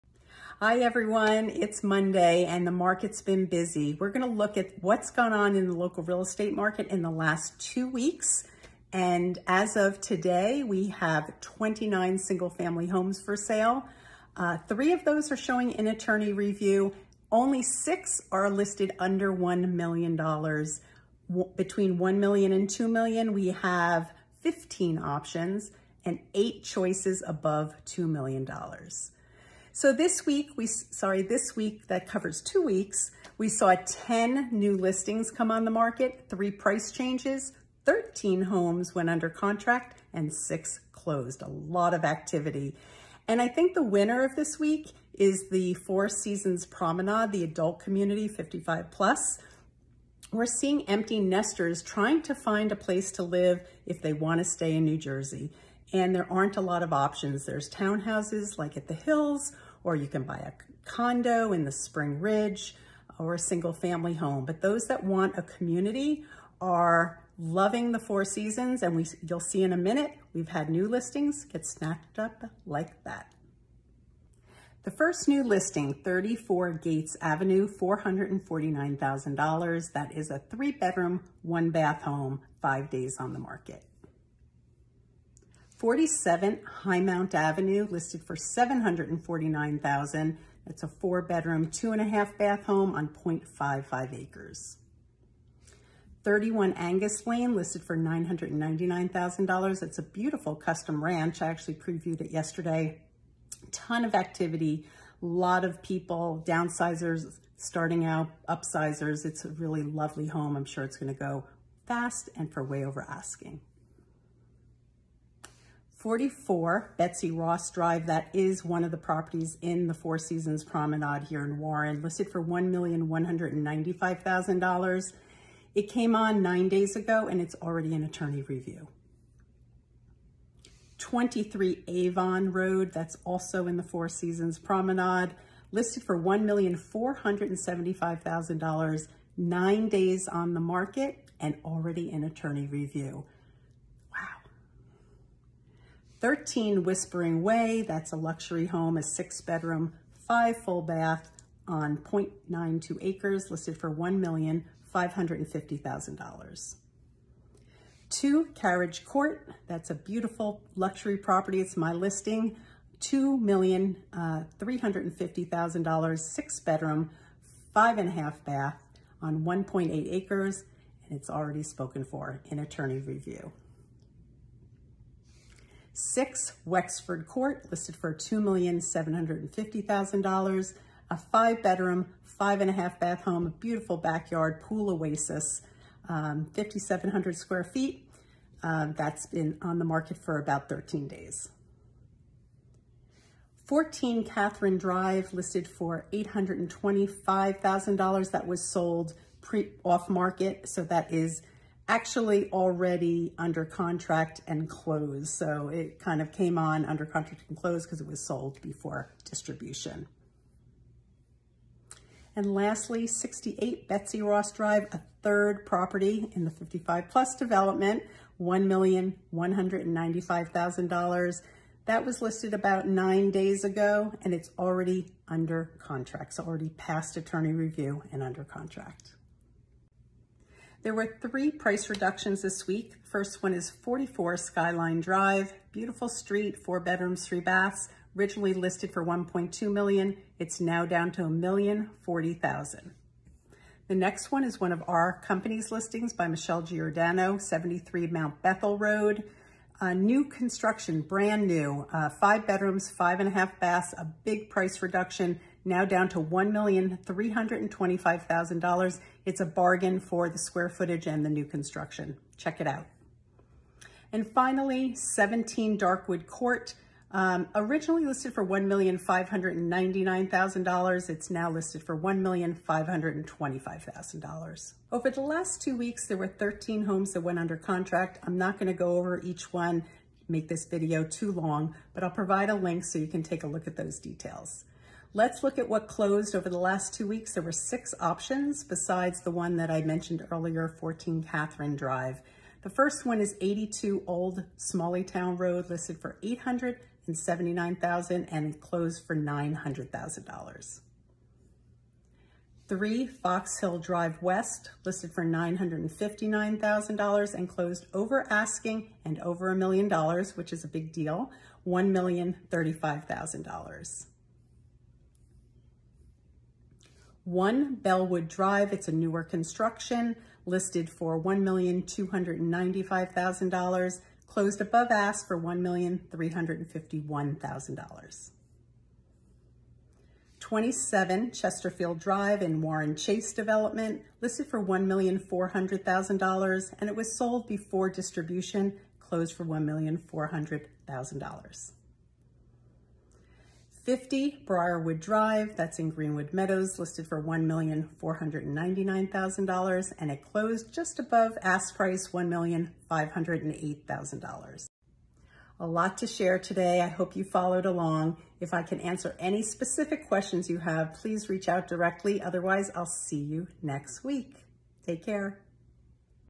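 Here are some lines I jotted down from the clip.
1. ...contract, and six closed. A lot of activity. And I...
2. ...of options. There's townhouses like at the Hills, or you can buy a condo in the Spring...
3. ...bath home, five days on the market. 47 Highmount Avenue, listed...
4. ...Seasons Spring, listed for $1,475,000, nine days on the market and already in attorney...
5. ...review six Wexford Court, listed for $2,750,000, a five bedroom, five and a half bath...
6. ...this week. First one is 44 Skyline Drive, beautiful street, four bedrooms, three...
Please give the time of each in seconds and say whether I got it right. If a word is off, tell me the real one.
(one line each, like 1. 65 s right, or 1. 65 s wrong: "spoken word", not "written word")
1. 39 s right
2. 56 s right
3. 81 s right
4. 134 s wrong: "Promenade", not "Spring"
5. 172 s right
6. 232 s right.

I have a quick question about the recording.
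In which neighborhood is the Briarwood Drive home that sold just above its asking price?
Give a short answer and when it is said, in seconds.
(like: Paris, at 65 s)
Greenwood Meadows, at 345 s.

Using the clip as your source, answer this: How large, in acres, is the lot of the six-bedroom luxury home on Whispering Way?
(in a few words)
0.92 acres.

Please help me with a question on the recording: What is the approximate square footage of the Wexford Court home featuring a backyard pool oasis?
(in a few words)
5,700.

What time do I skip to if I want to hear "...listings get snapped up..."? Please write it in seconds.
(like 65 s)
70 s.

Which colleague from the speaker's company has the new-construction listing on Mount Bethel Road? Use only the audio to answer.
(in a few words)
Michelle Giordano.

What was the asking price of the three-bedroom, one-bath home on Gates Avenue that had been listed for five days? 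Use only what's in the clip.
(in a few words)
$449,000.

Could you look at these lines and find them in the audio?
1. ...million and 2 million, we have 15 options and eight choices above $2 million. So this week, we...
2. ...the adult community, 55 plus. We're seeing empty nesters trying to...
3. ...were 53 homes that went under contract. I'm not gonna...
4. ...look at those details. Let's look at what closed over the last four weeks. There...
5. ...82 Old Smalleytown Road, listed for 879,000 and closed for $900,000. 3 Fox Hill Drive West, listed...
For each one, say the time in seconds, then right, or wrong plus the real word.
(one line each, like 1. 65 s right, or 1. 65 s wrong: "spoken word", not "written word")
1. 22 s right
2. 47 s right
3. 276 s wrong: "13", not "53"
4. 283 s wrong: "two", not "four"
5. 293 s right.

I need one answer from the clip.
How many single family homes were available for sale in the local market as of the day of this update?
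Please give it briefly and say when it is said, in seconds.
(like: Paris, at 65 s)
29, at 11 s.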